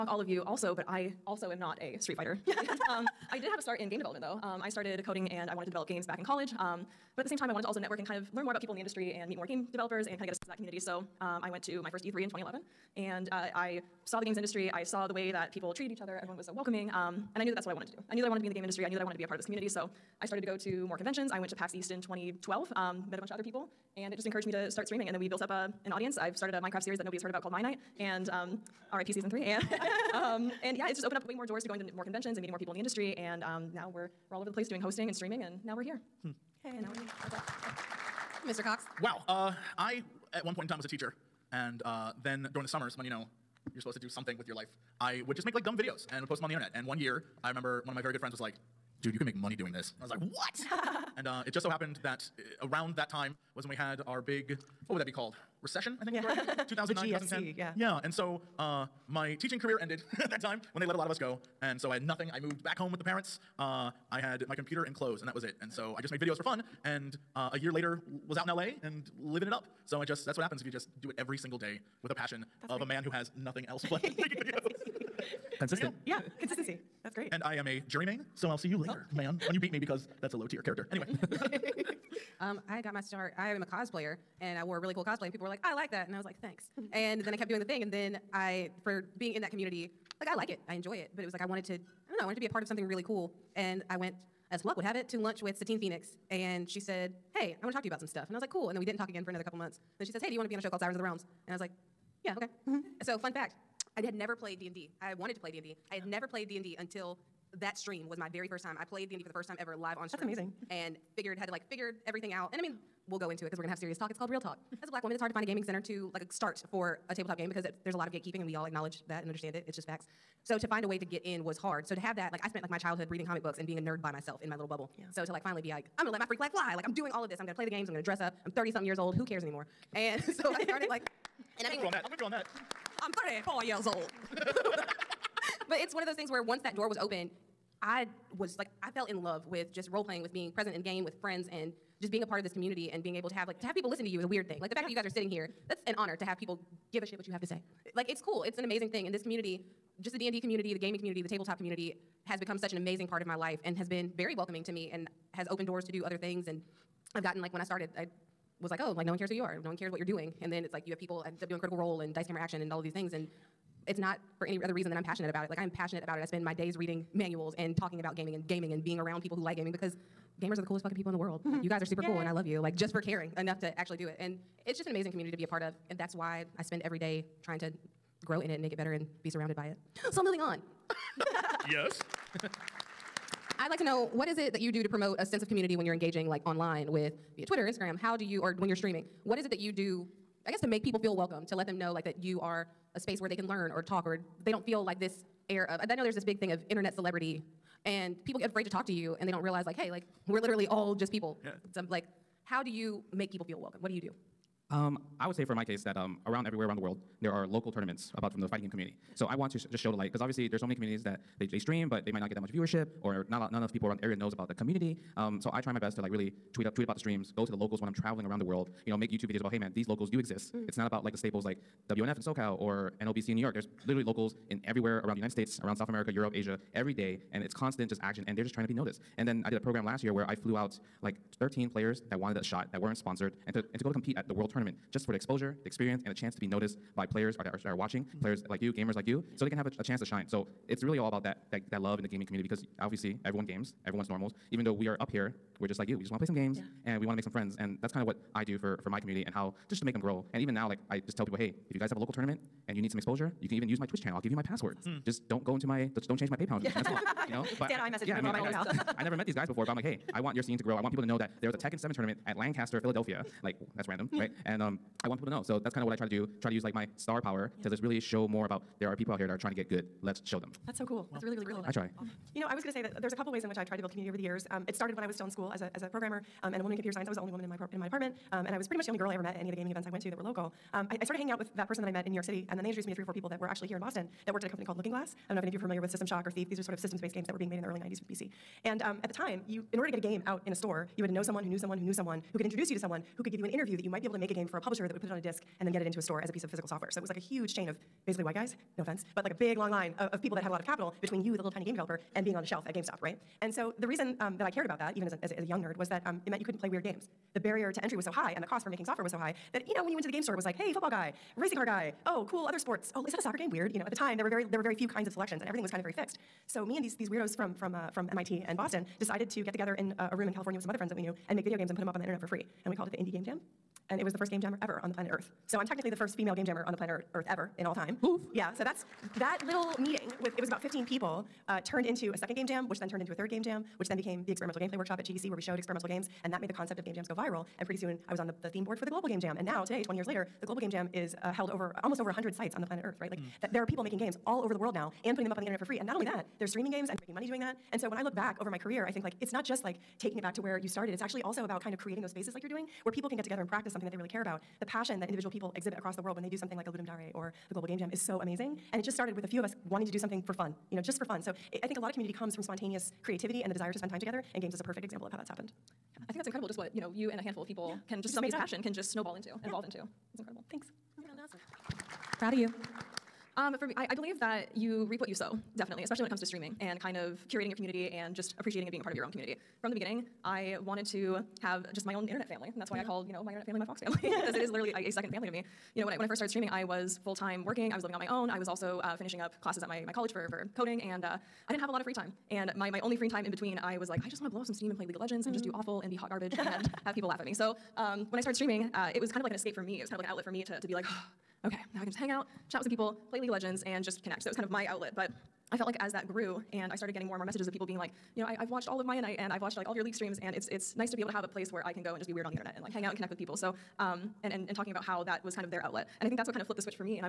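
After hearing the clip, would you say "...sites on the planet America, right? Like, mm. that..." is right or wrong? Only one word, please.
wrong.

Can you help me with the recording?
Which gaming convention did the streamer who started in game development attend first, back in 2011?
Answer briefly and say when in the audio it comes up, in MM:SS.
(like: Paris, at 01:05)
E3, at 00:12.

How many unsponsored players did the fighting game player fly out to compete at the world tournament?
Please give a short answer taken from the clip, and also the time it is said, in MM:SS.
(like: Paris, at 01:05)
13, at 03:51.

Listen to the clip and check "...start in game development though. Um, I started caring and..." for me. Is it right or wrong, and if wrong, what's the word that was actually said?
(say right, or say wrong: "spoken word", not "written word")
wrong: "coding", not "caring".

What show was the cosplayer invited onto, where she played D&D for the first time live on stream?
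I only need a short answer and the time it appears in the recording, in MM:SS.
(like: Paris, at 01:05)
Sirens of the Realms, at 01:40.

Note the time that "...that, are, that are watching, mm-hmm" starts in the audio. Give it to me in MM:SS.
03:57.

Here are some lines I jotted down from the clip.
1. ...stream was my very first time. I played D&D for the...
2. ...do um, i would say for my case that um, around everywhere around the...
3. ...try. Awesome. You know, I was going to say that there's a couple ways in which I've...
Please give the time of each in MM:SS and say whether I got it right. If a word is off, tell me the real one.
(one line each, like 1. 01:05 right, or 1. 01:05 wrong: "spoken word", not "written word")
1. 01:47 right
2. 03:24 right
3. 04:31 right.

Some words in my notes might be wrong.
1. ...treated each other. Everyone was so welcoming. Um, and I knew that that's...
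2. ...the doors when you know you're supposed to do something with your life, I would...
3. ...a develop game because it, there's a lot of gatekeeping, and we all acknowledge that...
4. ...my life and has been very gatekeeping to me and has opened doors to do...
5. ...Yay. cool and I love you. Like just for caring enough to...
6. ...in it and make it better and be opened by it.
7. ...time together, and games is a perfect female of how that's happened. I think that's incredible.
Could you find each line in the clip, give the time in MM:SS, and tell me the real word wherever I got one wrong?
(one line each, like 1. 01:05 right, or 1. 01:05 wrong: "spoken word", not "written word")
1. 00:15 right
2. 00:42 wrong: "summers", not "doors"
3. 01:57 wrong: "tabletop", not "develop"
4. 02:33 wrong: "welcoming", not "gatekeeping"
5. 02:52 right
6. 02:58 wrong: "surrounded", not "opened"
7. 06:03 wrong: "example", not "female".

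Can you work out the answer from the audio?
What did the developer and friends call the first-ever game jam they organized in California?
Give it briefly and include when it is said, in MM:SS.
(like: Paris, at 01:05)
Indie Game Jam, at 05:22.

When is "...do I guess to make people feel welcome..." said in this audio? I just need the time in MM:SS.
03:09.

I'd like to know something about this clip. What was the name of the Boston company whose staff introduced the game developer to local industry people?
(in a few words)
Looking Glass.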